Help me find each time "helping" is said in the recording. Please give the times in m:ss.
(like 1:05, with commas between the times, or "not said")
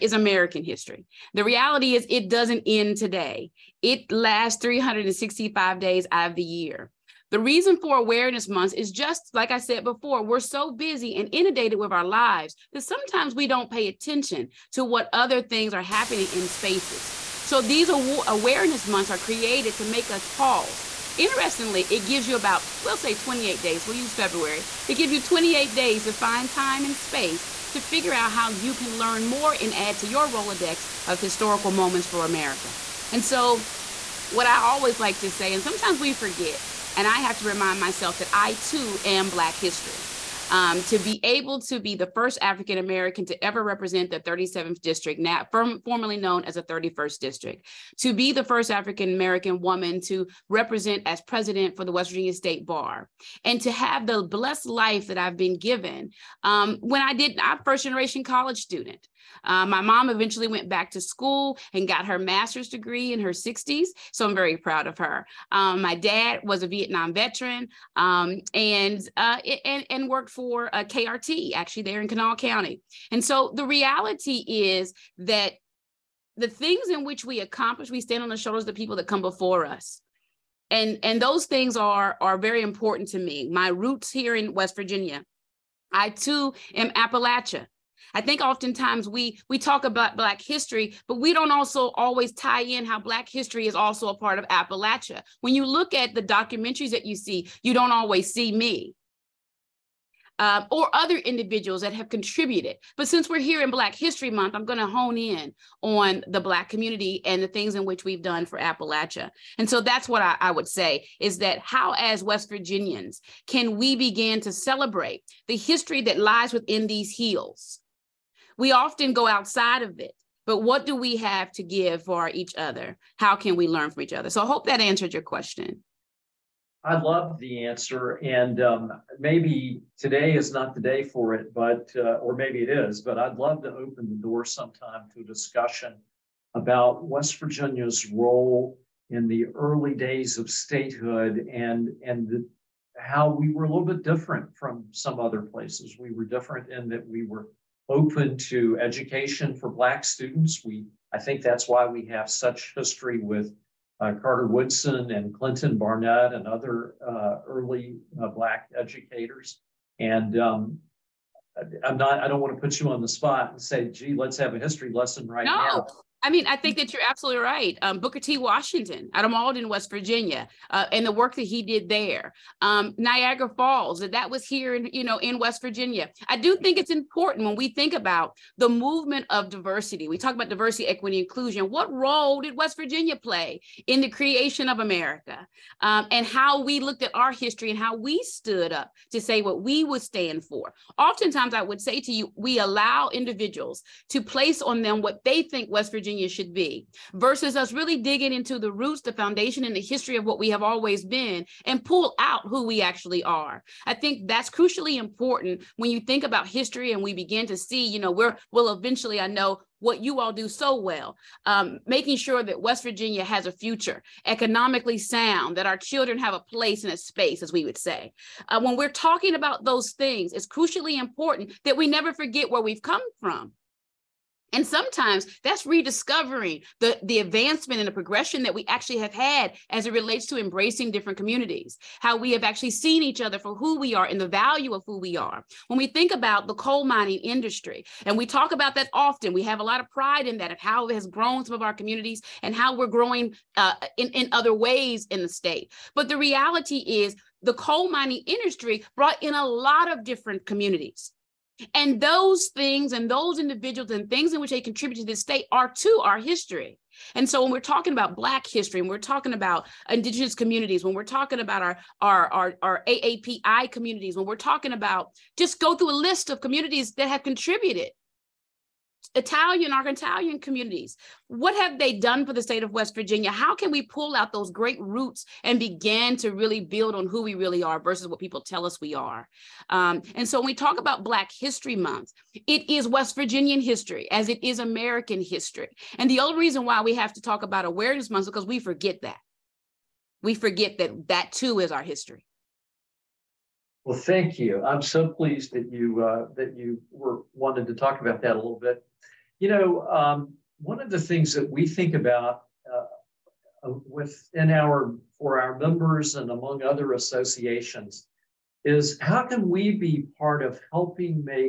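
5:10.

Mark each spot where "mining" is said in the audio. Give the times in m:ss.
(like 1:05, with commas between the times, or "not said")
3:56, 4:07.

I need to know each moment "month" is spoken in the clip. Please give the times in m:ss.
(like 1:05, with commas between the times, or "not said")
0:08, 0:18, 1:44, 4:41, 4:48.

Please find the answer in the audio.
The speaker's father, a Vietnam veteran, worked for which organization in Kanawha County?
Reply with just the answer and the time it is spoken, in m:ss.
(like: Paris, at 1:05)
KRT, at 1:10.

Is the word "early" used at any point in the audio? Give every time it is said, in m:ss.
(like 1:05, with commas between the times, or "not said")
2:19, 2:37.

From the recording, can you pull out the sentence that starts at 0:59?
Uh, my mom eventually went back to school and got her master's degree in her 60s.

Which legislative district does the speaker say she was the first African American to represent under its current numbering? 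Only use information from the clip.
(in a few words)
37th district.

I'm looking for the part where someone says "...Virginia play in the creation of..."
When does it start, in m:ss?
3:02.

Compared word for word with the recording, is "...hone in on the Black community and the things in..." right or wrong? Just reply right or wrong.
right.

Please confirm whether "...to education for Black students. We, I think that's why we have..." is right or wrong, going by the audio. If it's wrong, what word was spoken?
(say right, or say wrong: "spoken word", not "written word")
right.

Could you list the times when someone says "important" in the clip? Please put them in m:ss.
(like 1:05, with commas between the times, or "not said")
1:22, 2:56, 3:24, 3:40.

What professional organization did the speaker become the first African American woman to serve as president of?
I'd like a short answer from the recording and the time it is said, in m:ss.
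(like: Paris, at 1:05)
West Virginia State Bar, at 0:51.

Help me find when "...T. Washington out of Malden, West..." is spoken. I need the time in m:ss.
2:48.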